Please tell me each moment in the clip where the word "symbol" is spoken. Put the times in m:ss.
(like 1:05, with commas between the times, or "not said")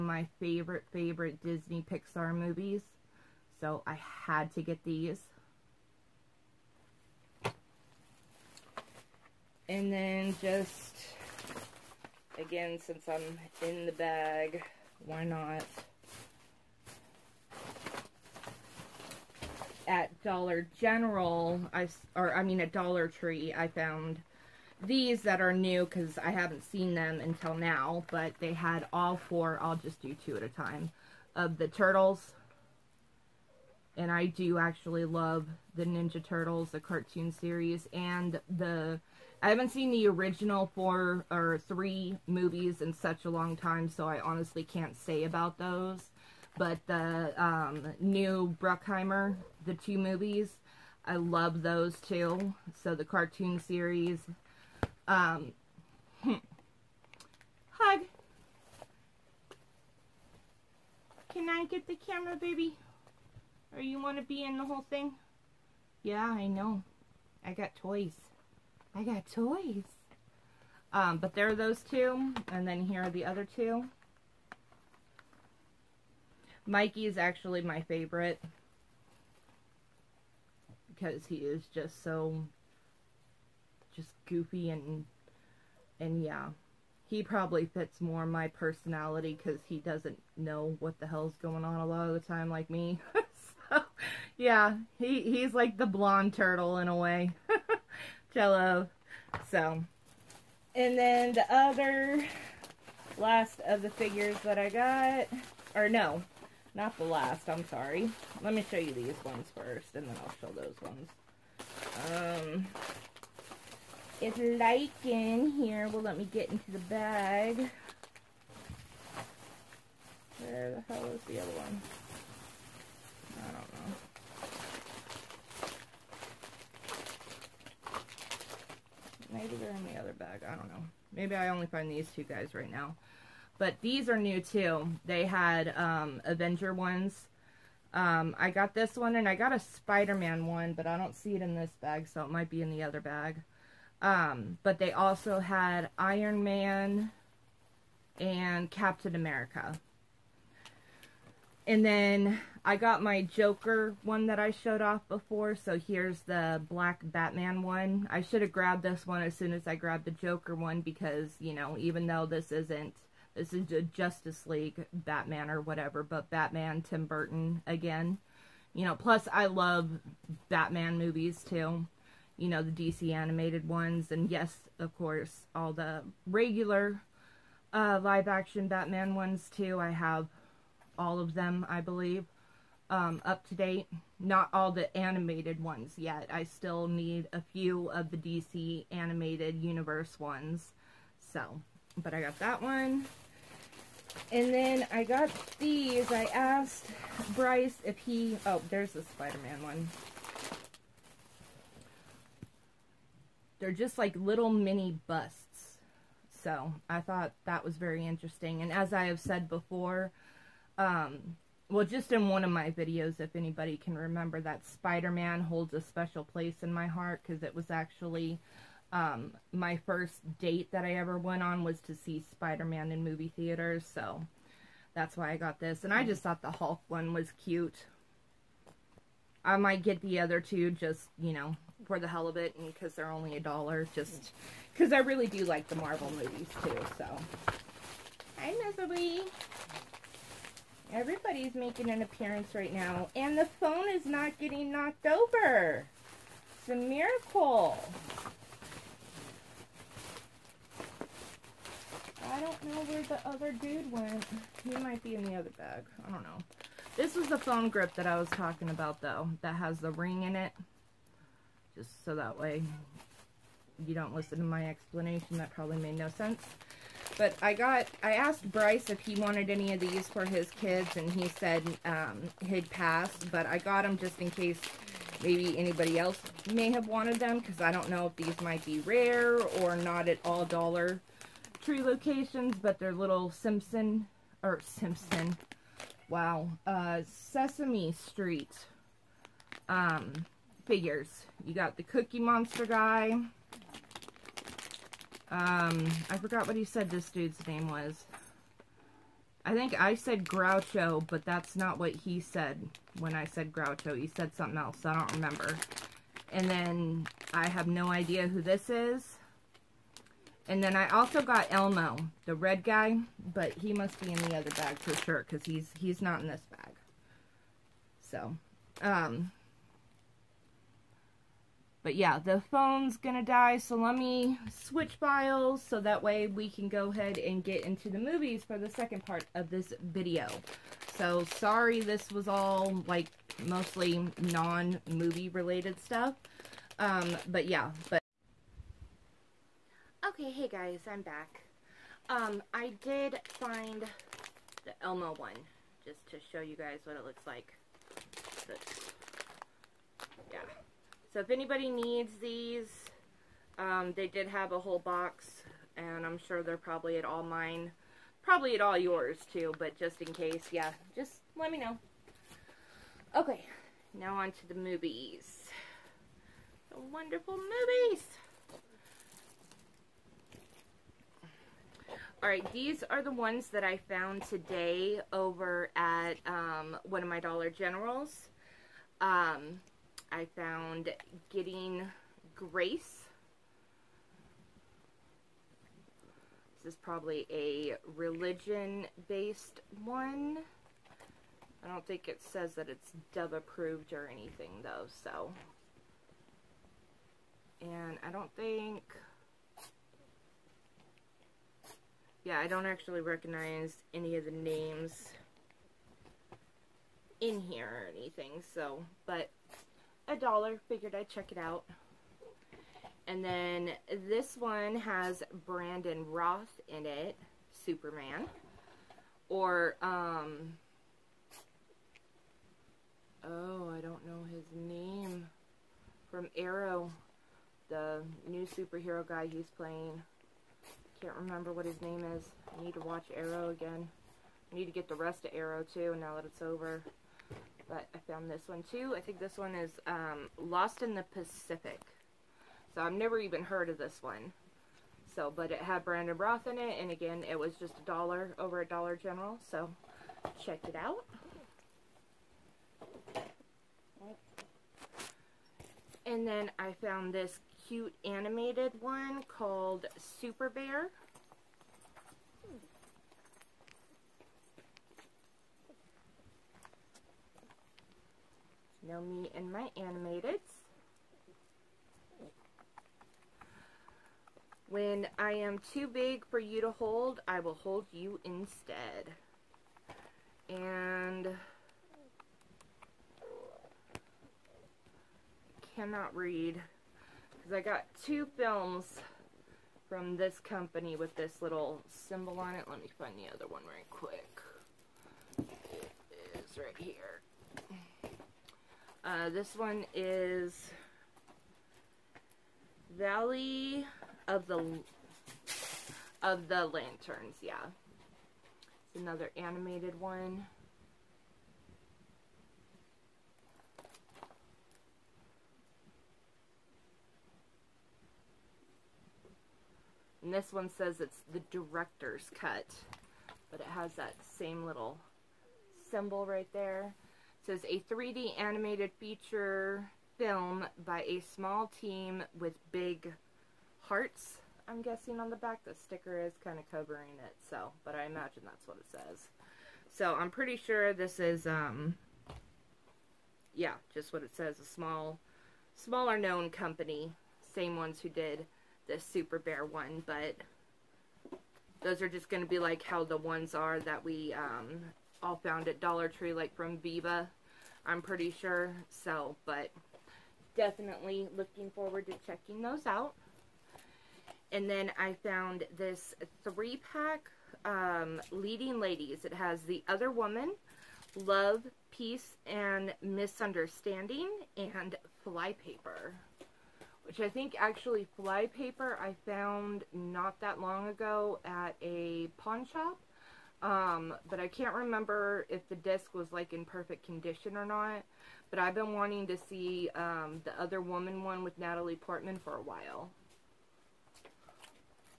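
8:11, 8:45.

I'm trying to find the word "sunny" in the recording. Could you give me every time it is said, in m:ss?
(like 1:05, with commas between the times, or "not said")
not said.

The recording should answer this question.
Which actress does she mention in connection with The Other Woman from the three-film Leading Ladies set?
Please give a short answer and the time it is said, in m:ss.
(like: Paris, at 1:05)
Natalie Portman, at 9:51.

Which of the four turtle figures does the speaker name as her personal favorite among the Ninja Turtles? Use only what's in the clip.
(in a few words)
Mikey.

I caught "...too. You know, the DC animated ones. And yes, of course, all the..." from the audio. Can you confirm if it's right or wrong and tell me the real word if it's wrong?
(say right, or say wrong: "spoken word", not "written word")
right.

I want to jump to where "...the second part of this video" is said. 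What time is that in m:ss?
5:28.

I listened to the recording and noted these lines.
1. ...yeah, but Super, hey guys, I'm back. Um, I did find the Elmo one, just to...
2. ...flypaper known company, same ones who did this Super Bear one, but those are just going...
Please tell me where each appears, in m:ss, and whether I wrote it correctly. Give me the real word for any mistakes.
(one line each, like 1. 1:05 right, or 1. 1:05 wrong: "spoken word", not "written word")
1. 5:37 wrong: "Okay", not "Super"
2. 9:05 wrong: "smaller", not "flypaper".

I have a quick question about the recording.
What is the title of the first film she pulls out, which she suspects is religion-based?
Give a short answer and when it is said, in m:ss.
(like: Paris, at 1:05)
Getting Grace, at 6:21.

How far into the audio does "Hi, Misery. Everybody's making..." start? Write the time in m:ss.
3:58.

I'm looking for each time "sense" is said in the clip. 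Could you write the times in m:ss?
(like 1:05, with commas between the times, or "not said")
4:26.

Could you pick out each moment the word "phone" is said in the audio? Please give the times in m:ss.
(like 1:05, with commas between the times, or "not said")
4:03, 4:17, 5:22.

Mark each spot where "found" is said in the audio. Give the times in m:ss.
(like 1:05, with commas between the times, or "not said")
0:23, 6:13, 6:20, 7:18, 7:36, 9:15, 9:25, 9:39.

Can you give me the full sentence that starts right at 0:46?
But the um, new Bruckheimer the two movies.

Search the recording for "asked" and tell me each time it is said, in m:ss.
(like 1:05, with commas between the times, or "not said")
3:16, 4:28.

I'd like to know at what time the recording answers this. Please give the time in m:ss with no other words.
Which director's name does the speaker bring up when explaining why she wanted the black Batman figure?
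2:46.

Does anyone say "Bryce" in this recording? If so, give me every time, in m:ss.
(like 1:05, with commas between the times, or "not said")
3:17, 4:28.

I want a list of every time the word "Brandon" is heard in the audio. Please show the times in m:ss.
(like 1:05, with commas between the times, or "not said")
6:55, 7:25.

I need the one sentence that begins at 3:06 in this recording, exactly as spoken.
I still need a few of the DC animated universe ones.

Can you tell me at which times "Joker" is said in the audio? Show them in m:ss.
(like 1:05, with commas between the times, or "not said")
2:33, 2:40.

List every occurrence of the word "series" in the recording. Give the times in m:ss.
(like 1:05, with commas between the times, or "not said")
0:37, 0:53.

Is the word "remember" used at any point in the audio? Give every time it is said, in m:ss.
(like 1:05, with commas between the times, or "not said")
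3:33, 5:05, 7:11, 9:44.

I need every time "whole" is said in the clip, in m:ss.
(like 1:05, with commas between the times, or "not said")
1:04, 5:54.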